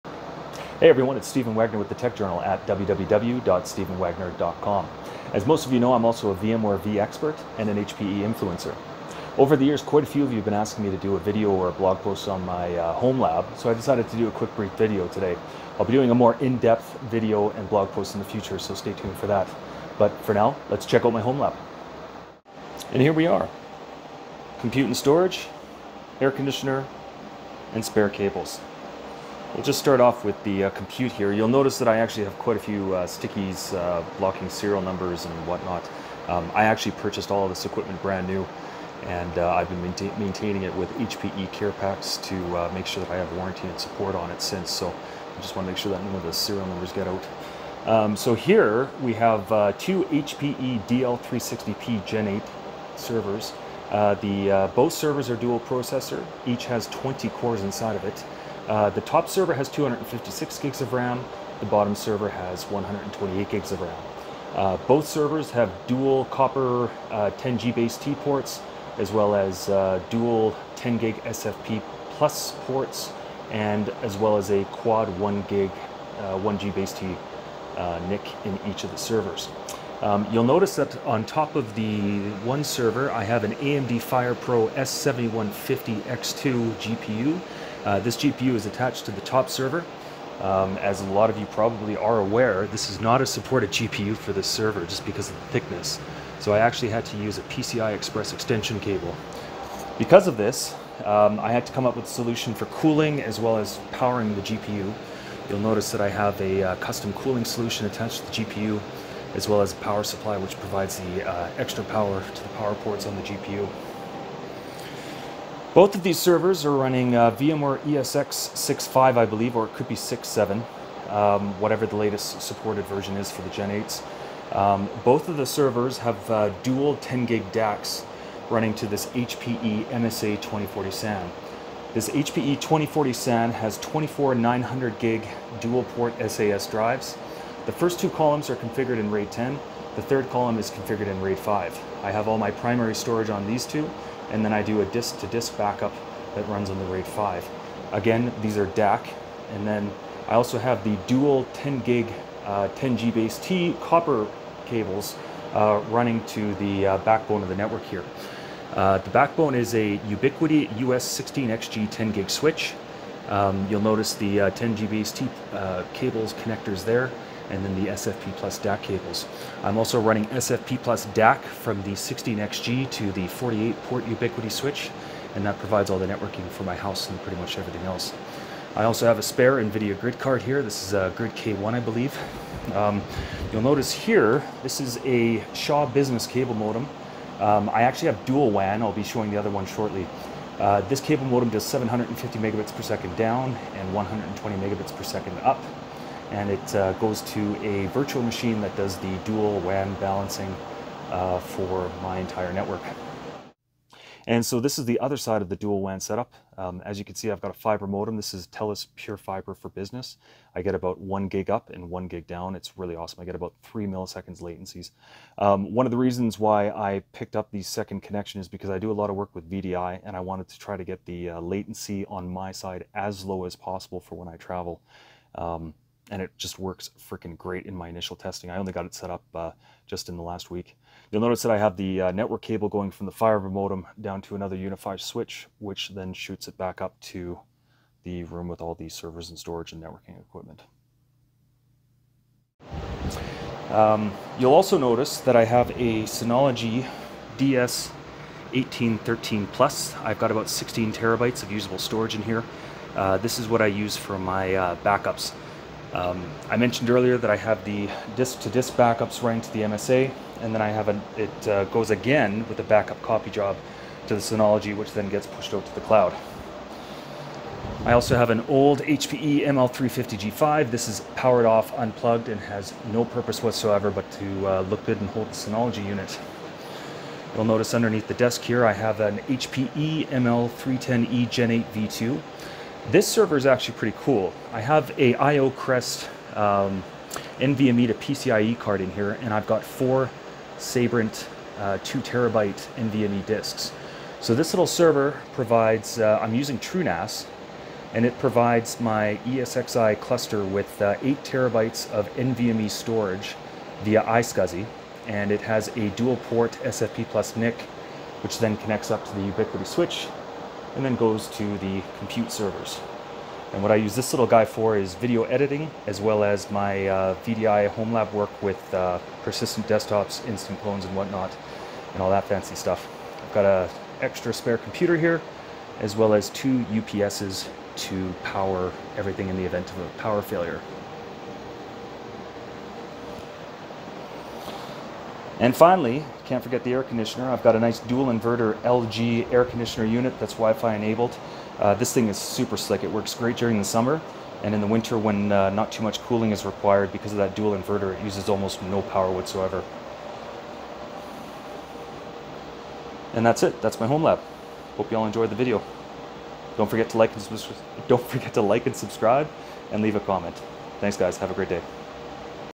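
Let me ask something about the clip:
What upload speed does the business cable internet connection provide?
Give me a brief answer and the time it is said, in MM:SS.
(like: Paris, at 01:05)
120 Mbps, at 03:13.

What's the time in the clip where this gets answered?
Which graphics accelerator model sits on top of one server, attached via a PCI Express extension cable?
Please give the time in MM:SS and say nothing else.
01:23.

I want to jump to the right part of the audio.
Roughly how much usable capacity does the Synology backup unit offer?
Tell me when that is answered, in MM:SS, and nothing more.
04:10.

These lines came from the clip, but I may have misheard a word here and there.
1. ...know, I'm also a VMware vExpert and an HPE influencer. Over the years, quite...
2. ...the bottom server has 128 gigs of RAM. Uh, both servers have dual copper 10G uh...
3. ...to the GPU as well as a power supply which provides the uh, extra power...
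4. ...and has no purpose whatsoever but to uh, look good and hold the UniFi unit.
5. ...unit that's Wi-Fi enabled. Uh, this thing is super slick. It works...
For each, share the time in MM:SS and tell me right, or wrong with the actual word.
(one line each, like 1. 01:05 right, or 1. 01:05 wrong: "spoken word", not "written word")
1. 00:05 right
2. 01:01 right
3. 01:48 right
4. 04:32 wrong: "Synology", not "UniFi"
5. 05:39 right.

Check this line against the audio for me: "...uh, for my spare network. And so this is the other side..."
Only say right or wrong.
wrong.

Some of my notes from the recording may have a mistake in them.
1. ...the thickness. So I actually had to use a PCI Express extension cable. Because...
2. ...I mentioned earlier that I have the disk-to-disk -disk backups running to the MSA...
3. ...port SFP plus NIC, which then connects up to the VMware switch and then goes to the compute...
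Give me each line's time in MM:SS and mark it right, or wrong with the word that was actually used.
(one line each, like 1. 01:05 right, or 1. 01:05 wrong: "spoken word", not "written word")
1. 01:35 right
2. 04:16 right
3. 05:06 wrong: "Ubiquiti", not "VMware".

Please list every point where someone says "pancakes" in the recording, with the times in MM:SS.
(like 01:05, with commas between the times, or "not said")
not said.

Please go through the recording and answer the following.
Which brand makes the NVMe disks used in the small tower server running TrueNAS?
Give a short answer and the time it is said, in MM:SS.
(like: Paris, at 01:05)
Sabrent, at 04:50.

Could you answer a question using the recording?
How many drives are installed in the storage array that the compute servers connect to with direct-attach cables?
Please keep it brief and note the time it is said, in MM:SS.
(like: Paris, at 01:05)
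24, at 02:13.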